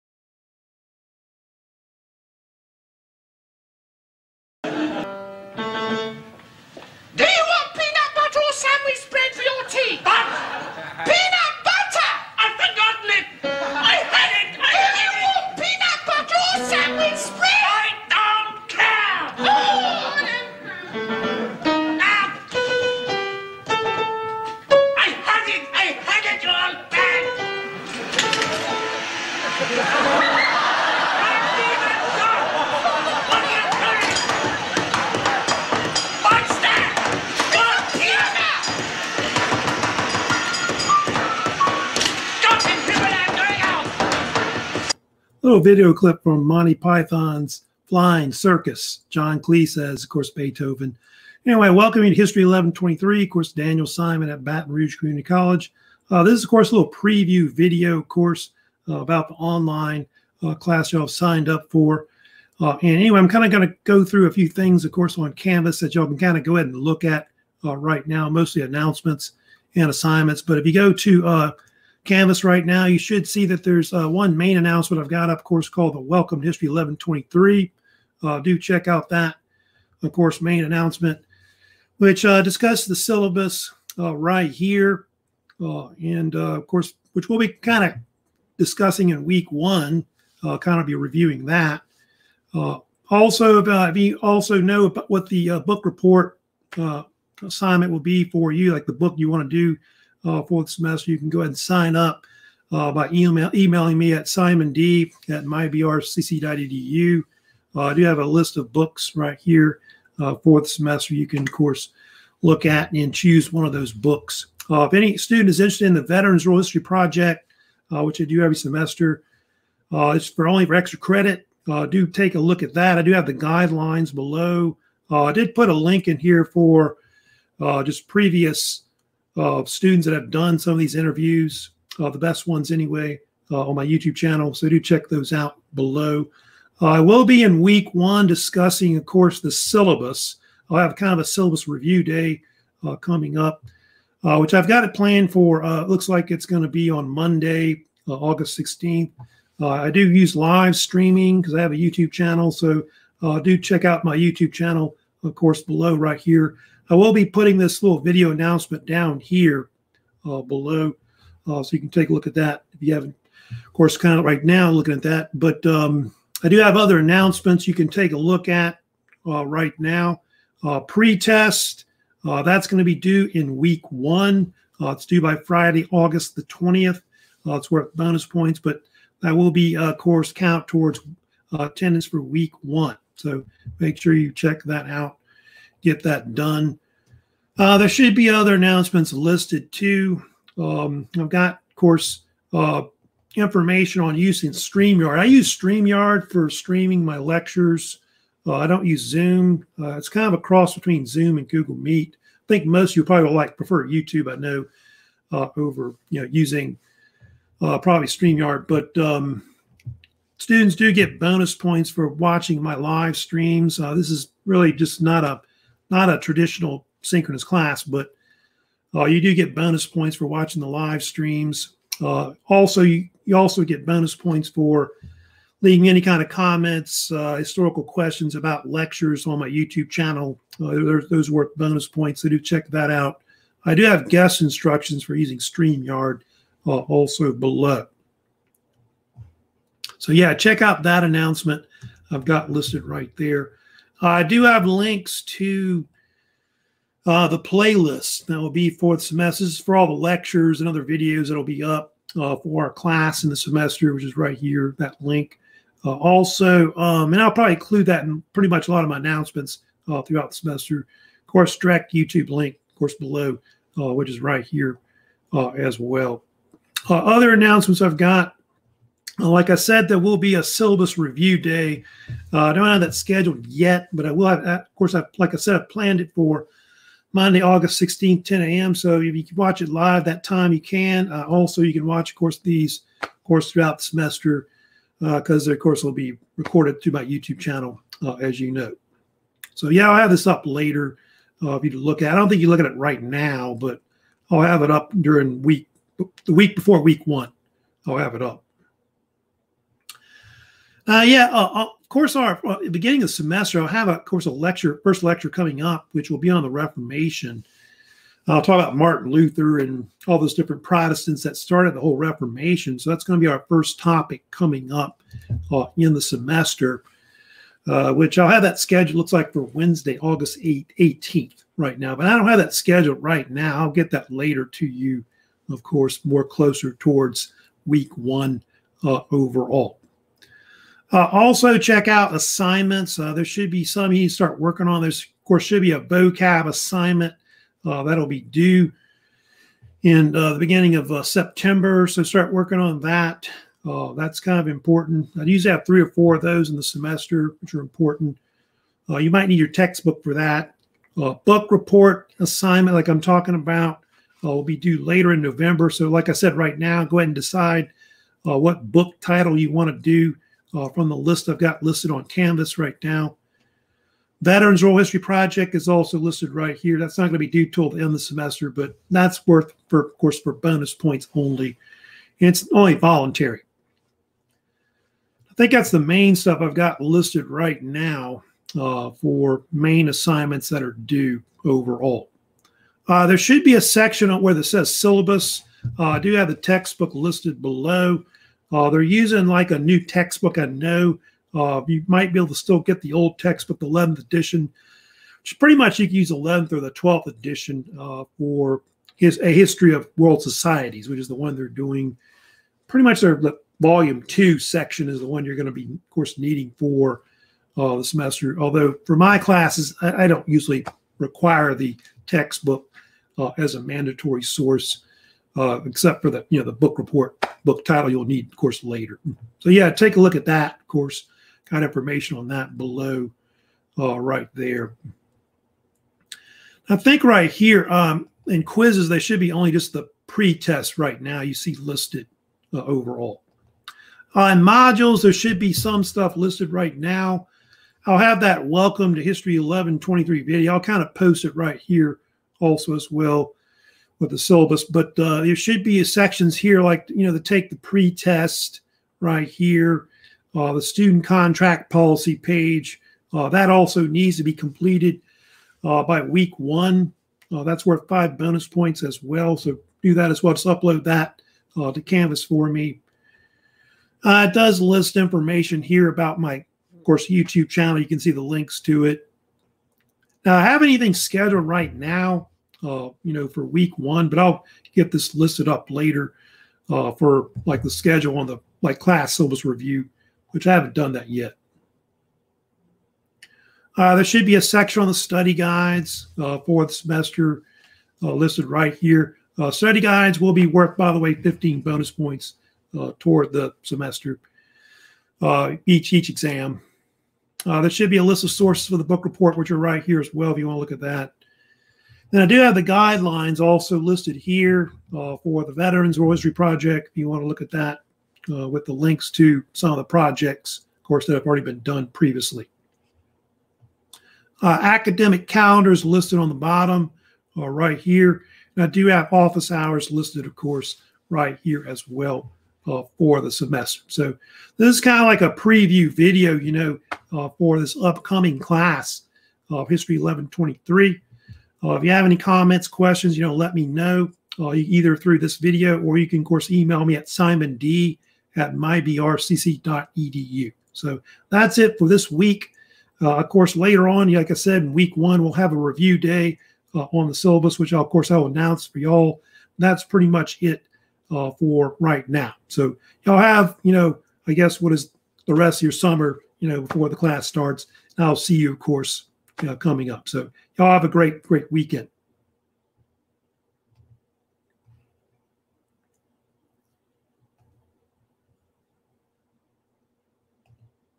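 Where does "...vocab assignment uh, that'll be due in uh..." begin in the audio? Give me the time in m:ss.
5:35.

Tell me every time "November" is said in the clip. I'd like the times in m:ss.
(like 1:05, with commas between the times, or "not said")
5:55.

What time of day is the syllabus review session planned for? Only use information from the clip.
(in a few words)
10 a.m.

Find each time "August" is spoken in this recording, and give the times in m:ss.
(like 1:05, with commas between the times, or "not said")
2:28, 2:55, 4:37, 5:19.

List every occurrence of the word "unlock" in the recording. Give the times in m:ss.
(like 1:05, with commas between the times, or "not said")
not said.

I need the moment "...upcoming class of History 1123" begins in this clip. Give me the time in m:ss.
8:47.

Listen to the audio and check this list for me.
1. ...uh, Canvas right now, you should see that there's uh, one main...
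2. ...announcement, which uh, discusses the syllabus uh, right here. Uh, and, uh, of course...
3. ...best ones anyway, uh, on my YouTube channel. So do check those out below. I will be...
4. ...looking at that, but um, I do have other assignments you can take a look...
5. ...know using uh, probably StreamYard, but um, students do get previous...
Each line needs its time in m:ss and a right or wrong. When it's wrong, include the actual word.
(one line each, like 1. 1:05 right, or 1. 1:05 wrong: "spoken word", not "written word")
1. 1:11 right
2. 1:20 right
3. 2:12 right
4. 2:44 wrong: "announcements", not "assignments"
5. 3:26 wrong: "bonus", not "previous".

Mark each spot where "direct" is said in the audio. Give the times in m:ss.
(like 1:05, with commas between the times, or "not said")
4:21.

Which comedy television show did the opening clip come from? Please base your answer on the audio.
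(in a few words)
Monty Python's Flying Circus.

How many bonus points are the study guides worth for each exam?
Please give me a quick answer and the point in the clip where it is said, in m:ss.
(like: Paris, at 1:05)
15, at 8:11.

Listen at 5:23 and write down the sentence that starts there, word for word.
I'll get that later to you, of course, more closer towards week one uh, overall.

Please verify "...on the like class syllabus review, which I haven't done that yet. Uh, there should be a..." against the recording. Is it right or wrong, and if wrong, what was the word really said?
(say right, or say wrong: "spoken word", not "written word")
right.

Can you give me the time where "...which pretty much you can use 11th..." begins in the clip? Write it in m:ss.
6:35.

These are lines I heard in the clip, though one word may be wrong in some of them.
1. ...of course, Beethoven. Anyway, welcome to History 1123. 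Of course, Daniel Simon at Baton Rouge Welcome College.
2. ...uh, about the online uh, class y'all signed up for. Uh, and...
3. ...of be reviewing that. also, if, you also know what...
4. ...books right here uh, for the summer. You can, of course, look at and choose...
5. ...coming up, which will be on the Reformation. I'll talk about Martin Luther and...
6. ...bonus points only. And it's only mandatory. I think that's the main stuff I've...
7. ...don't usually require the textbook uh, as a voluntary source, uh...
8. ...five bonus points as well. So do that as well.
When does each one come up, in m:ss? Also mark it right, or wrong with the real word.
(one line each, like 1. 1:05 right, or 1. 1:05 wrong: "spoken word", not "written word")
1. 0:50 wrong: "Community", not "Welcome"
2. 0:58 right
3. 1:30 right
4. 1:48 wrong: "semester", not "summer"
5. 5:05 right
6. 6:10 wrong: "voluntary", not "mandatory"
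7. 6:50 wrong: "mandatory", not "voluntary"
8. 7:37 right.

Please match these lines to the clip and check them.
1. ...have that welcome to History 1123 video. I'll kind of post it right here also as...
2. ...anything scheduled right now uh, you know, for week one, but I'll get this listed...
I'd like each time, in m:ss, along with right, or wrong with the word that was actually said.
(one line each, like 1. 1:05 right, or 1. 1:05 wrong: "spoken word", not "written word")
1. 7:17 right
2. 7:50 right.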